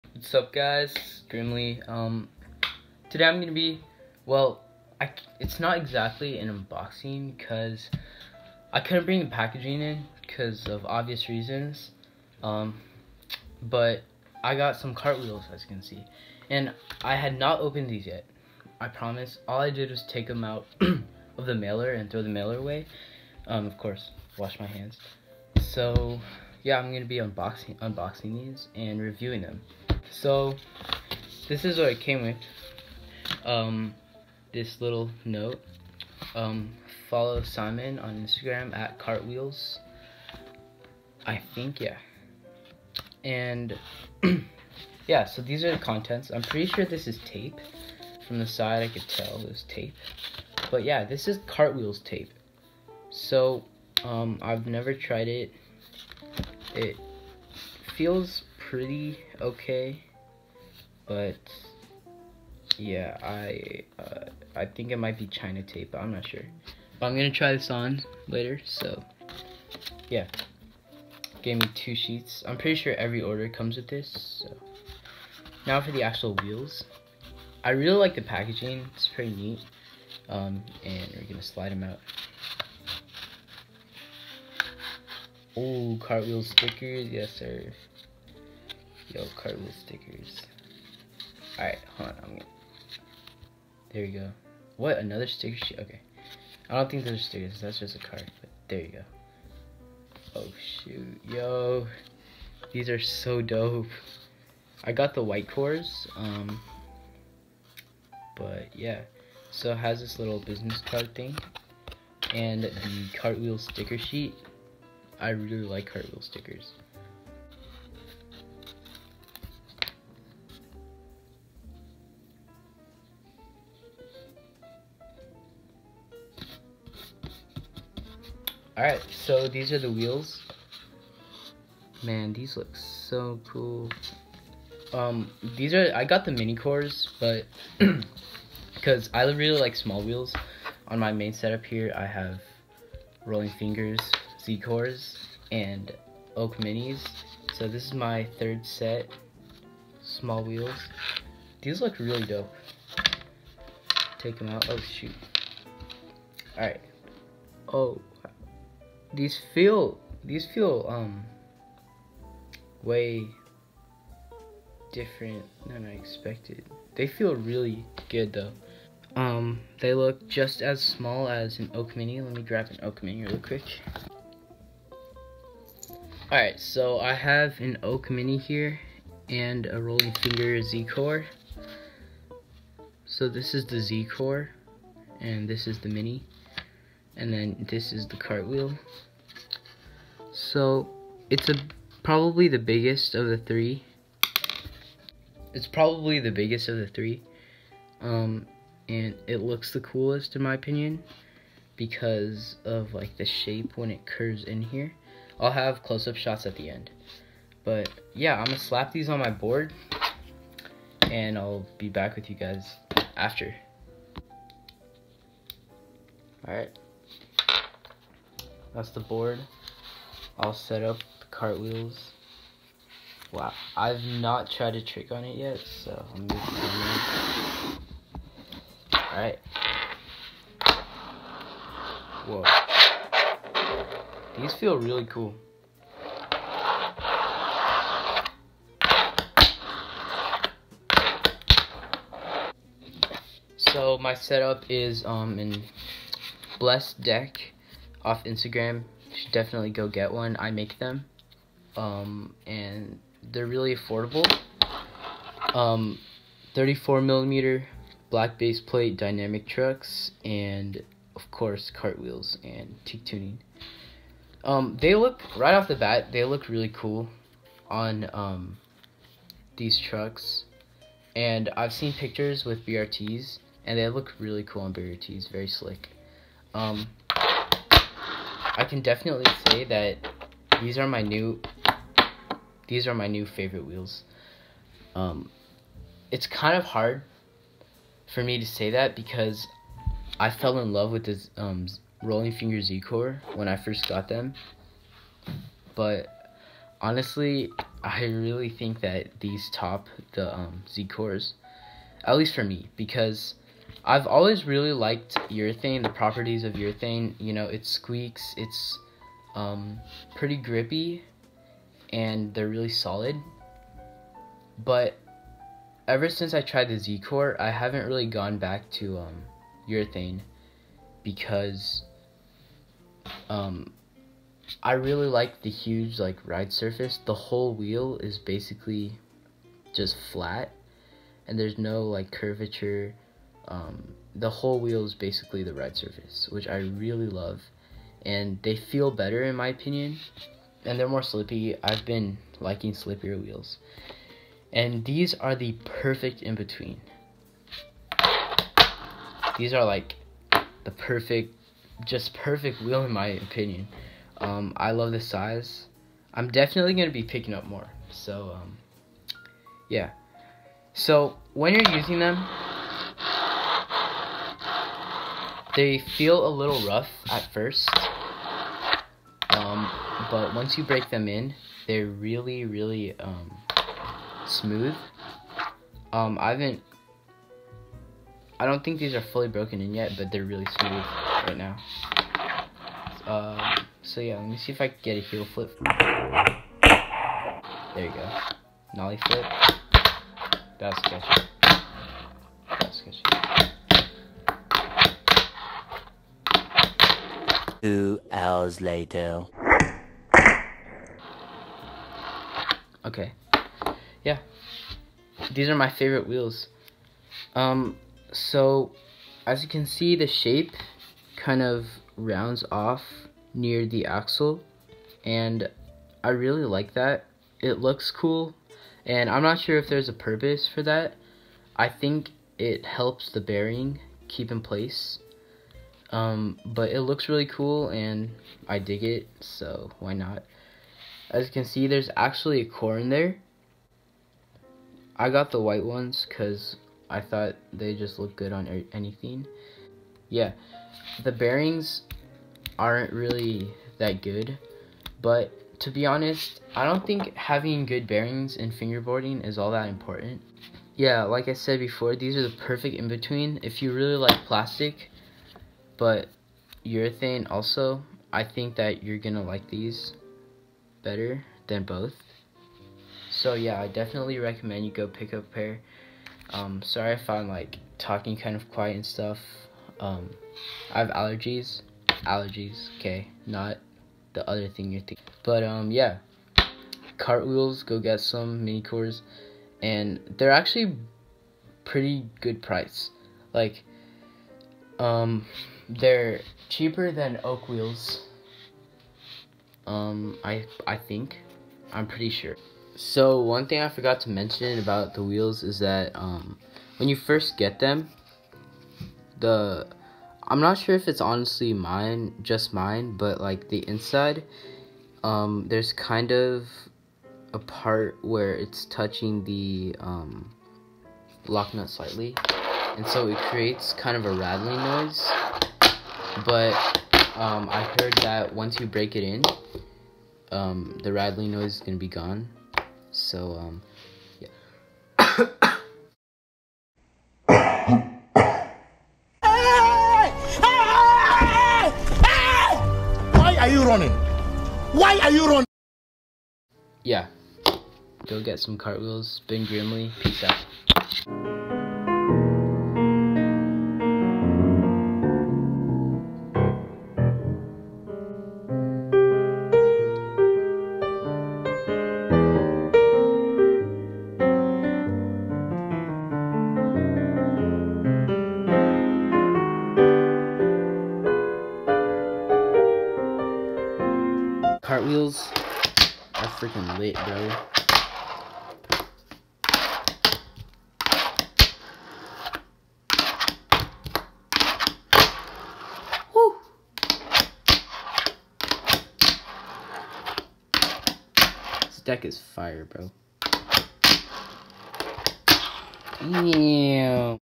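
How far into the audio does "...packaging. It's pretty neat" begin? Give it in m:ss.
1:18.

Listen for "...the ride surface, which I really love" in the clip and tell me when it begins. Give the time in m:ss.
5:35.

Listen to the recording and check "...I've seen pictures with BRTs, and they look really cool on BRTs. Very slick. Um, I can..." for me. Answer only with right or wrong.
right.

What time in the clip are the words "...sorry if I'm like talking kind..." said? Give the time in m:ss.
7:46.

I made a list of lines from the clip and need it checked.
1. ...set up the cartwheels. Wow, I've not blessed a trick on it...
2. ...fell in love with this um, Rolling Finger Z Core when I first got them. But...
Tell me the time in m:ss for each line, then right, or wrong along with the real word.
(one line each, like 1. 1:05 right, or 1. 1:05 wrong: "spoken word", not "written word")
1. 3:40 wrong: "tried", not "blessed"
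2. 4:50 right.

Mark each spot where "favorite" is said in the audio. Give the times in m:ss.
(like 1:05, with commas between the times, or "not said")
4:43, 6:45.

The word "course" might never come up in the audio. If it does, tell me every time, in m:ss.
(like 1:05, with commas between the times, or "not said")
0:23, 4:21.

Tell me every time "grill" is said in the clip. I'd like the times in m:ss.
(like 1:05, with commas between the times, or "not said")
not said.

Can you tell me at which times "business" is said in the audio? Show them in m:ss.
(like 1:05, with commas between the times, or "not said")
1:50.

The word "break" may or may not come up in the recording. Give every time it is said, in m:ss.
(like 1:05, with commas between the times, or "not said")
6:10, 8:38.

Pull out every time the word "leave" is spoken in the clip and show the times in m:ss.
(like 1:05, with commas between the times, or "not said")
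not said.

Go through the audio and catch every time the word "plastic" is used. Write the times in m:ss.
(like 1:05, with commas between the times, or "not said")
7:34.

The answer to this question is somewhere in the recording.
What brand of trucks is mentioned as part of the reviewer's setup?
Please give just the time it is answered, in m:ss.
4:18.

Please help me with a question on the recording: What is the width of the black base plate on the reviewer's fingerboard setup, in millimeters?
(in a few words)
34.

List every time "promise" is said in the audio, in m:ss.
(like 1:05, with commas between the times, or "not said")
0:18.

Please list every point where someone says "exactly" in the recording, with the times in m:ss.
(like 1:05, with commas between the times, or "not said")
0:05.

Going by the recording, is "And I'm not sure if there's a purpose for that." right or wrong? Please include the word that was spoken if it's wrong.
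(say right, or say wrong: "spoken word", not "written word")
right.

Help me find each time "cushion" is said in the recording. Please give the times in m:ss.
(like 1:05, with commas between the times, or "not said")
not said.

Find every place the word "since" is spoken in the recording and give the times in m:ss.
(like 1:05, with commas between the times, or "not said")
5:16.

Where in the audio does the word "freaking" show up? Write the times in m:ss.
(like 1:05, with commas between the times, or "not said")
9:26.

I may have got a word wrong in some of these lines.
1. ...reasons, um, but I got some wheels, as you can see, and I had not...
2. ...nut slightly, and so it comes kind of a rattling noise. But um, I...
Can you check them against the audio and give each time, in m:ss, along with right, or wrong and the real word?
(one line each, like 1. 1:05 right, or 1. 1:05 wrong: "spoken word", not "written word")
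1. 0:11 wrong: "cartwheels", not "wheels"
2. 8:31 wrong: "creates", not "comes".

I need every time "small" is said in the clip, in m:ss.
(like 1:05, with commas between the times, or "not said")
2:19, 2:30, 2:50.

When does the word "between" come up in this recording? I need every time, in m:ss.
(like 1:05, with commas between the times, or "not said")
5:46, 7:32.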